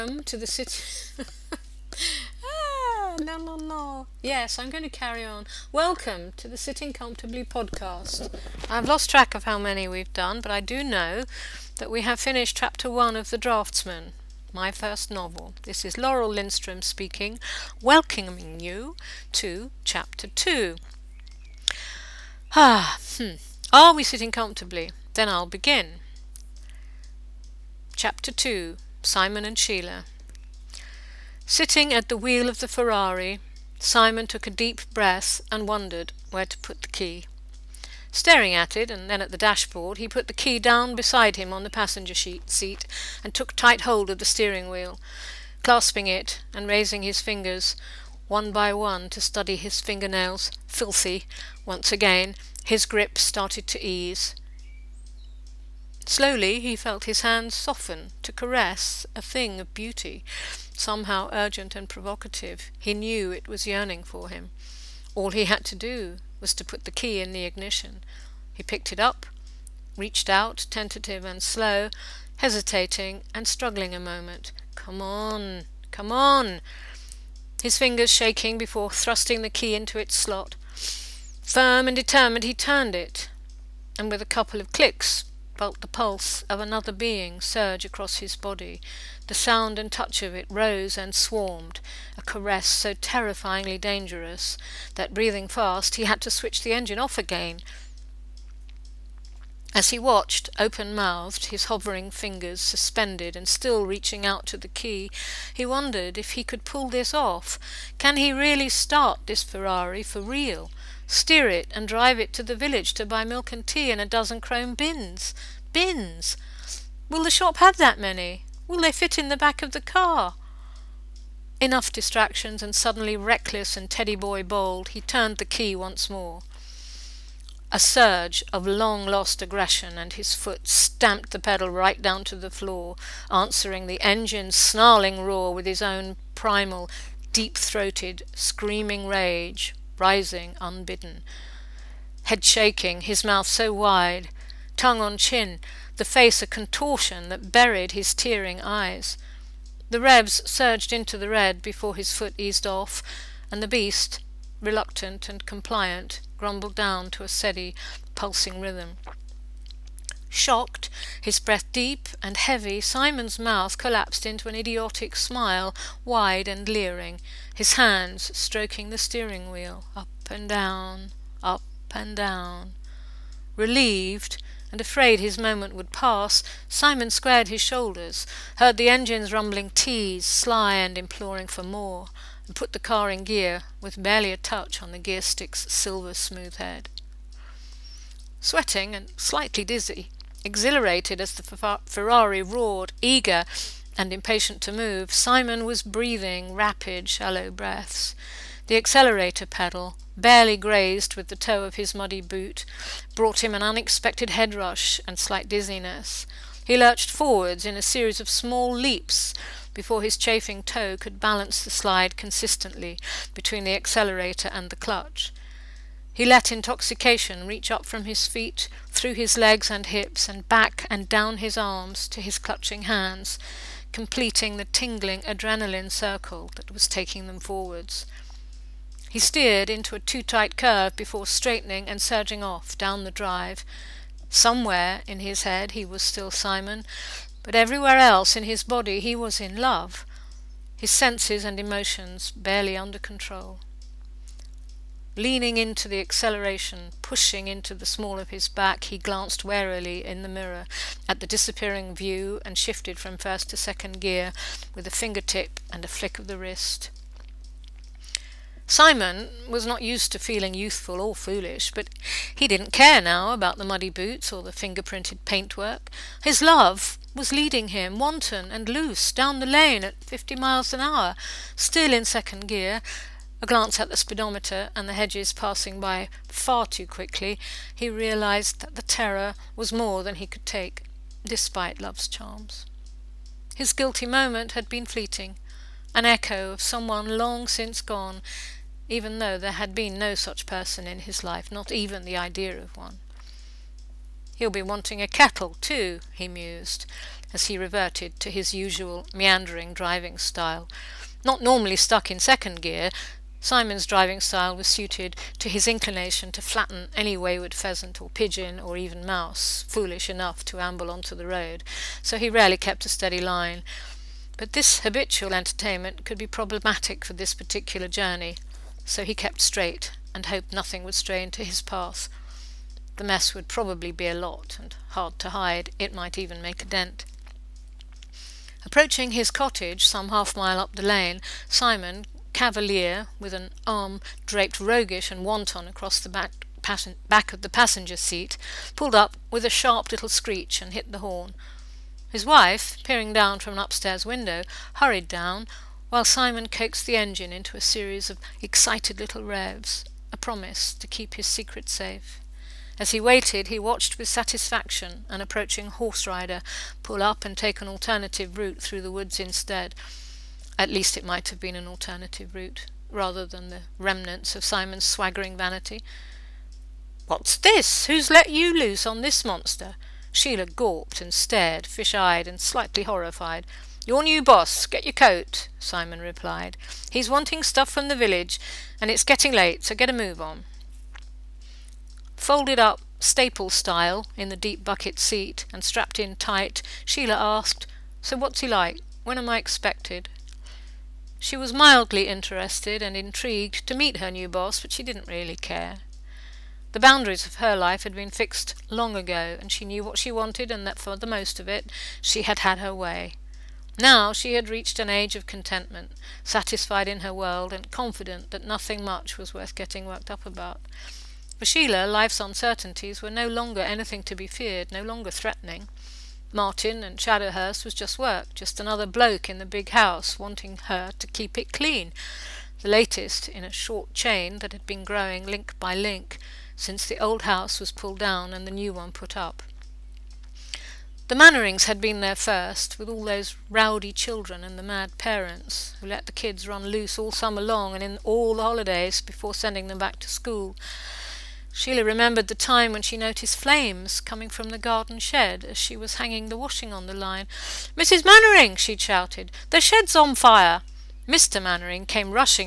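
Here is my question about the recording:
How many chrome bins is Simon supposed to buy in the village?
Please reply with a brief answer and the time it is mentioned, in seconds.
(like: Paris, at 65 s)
12, at 114 s.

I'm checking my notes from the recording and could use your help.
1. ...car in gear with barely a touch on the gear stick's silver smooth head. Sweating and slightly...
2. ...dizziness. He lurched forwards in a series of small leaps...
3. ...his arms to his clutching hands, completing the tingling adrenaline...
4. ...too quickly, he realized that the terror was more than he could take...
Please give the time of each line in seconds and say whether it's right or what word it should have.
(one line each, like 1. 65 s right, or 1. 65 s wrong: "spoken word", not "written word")
1. 182 s right
2. 205 s right
3. 221 s right
4. 276 s right.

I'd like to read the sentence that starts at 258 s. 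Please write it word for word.
Simon was not used to feeling youthful or foolish, but he didn't care now about the muddy boots or the finger-printed paintwork.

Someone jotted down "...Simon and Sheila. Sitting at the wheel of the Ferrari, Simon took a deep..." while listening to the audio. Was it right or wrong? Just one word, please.
right.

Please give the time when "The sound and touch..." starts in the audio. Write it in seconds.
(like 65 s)
89 s.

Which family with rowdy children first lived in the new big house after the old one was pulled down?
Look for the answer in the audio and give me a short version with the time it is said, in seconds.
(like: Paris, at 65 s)
The Mannerings, at 431 s.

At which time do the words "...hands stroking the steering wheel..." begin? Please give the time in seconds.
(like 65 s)
167 s.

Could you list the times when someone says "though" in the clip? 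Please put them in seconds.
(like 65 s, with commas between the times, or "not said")
289 s.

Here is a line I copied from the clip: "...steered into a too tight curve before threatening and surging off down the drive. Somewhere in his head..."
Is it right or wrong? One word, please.
wrong.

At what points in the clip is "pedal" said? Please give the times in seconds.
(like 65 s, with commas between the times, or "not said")
131 s, 199 s.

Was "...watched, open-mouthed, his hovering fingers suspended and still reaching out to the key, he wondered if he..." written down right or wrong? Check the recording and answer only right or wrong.
right.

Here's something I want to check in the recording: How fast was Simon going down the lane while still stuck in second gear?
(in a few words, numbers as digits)
50 miles an hour.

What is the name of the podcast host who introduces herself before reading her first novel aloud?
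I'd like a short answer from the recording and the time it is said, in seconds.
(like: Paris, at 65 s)
Laurel Lindstrom, at 15 s.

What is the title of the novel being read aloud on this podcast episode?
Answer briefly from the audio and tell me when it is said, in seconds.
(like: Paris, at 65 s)
The Draftsman, at 13 s.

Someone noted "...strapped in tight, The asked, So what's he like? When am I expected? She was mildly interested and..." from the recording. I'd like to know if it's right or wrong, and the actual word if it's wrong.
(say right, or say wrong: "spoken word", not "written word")
wrong: "Sheila", not "The".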